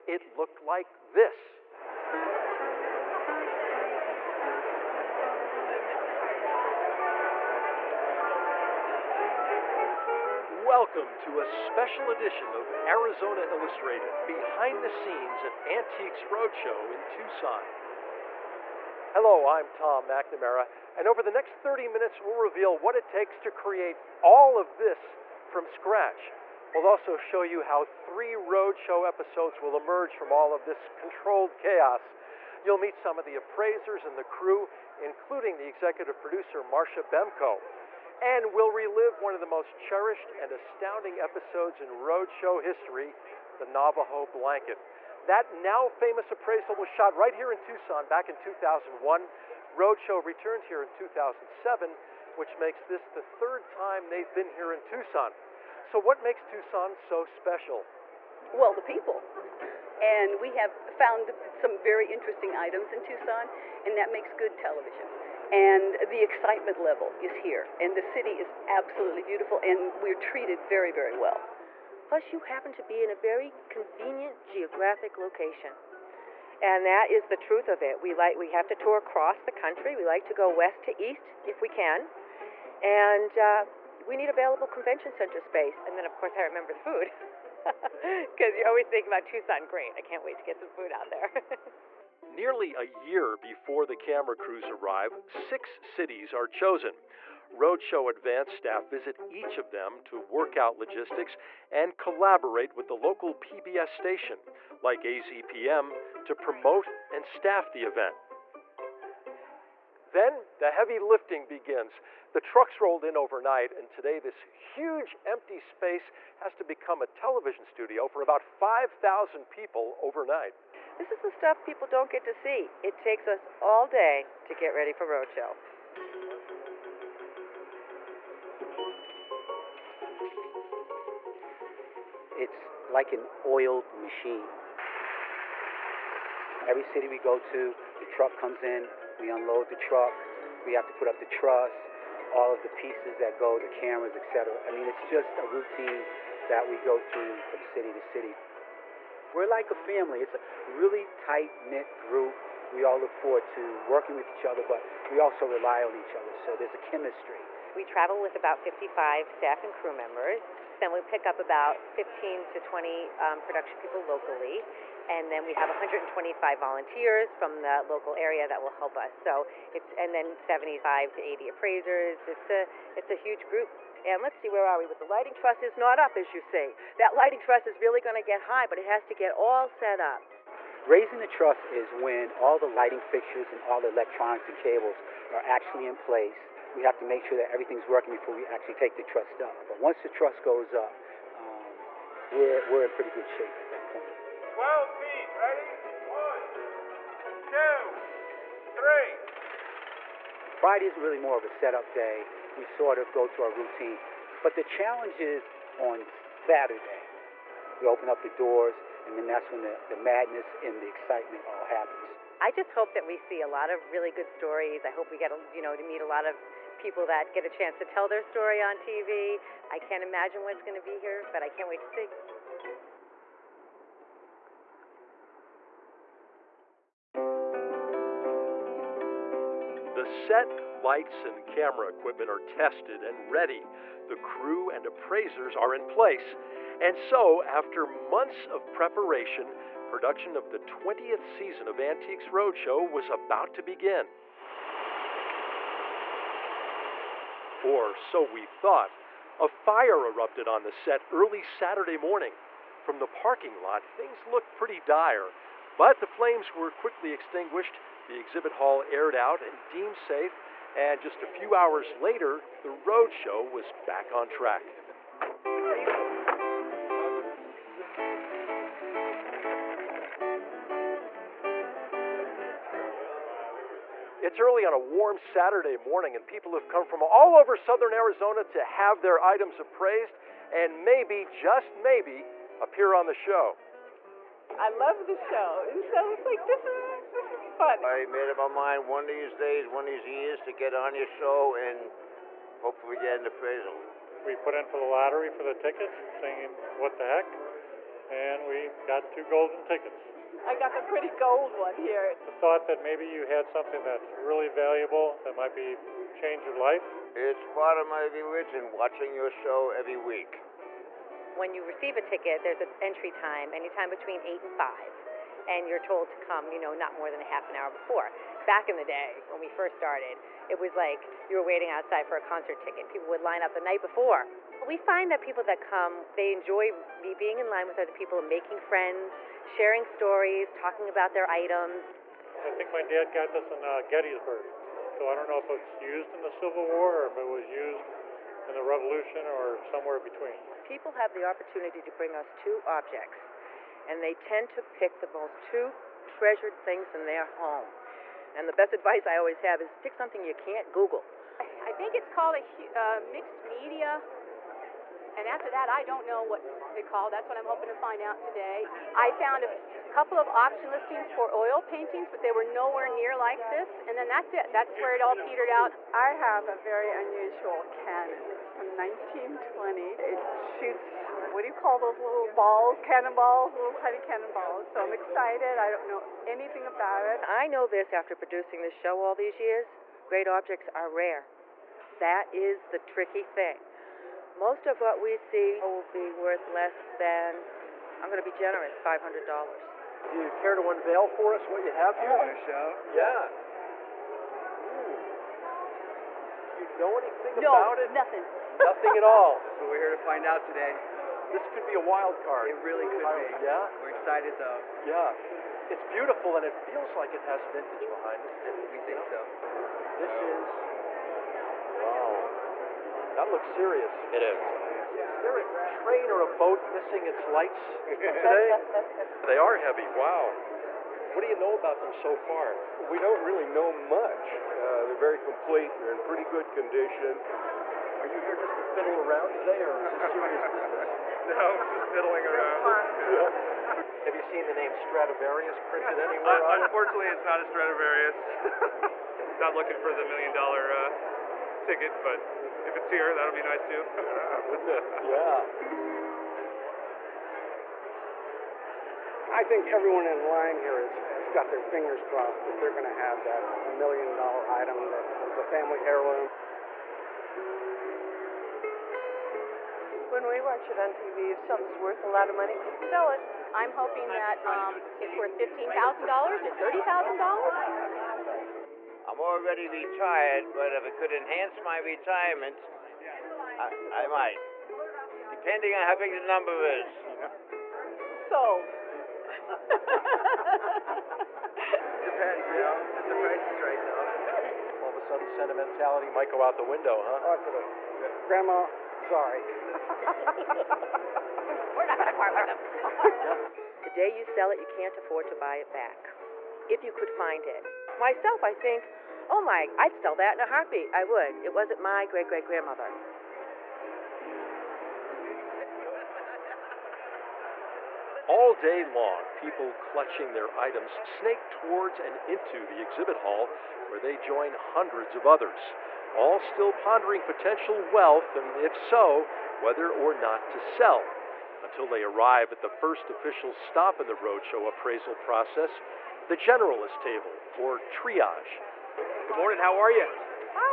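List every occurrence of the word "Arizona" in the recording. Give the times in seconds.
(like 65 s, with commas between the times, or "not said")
12 s, 277 s.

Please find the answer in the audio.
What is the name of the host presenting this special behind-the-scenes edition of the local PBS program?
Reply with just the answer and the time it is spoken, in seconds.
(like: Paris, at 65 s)
Tom McNamara, at 19 s.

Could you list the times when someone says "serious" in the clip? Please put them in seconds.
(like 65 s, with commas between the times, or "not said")
413 s, 430 s.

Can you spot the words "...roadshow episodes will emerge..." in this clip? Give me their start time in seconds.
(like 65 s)
28 s.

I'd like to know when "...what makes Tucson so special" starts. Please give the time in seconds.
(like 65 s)
55 s.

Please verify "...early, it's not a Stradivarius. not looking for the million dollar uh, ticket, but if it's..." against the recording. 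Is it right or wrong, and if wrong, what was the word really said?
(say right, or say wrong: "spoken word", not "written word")
wrong: "unfortunately", not "early".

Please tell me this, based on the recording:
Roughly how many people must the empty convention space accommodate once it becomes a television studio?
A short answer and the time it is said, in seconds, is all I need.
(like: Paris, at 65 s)
5,000, at 118 s.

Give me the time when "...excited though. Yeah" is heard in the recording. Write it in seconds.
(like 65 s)
403 s.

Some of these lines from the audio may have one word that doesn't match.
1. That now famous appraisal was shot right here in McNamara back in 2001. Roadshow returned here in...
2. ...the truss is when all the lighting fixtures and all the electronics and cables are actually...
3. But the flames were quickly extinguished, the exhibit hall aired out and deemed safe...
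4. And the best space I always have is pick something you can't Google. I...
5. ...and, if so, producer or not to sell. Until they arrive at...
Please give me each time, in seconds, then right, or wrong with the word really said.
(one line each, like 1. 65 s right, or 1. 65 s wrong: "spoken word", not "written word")
1. 45 s wrong: "Tucson", not "McNamara"
2. 181 s right
3. 255 s right
4. 348 s wrong: "advice", not "space"
5. 518 s wrong: "whether", not "producer".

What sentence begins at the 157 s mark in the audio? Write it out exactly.
We travel with about 55 staff and crew members.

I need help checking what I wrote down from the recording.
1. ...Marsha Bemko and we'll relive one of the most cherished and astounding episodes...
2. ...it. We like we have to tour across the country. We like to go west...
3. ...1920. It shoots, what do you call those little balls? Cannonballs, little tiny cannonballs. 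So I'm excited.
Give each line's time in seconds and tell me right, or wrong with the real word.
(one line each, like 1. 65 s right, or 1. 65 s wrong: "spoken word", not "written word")
1. 36 s right
2. 77 s right
3. 368 s right.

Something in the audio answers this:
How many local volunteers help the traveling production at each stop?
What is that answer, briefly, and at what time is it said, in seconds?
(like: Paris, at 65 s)
125, at 165 s.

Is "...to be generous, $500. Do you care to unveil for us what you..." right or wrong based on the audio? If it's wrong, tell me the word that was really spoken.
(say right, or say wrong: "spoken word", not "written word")
right.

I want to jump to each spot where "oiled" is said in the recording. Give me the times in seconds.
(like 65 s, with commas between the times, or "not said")
133 s.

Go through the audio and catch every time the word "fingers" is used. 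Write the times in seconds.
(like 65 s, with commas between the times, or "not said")
451 s.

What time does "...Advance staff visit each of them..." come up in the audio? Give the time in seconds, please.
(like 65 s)
98 s.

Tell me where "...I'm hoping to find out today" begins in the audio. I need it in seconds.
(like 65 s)
357 s.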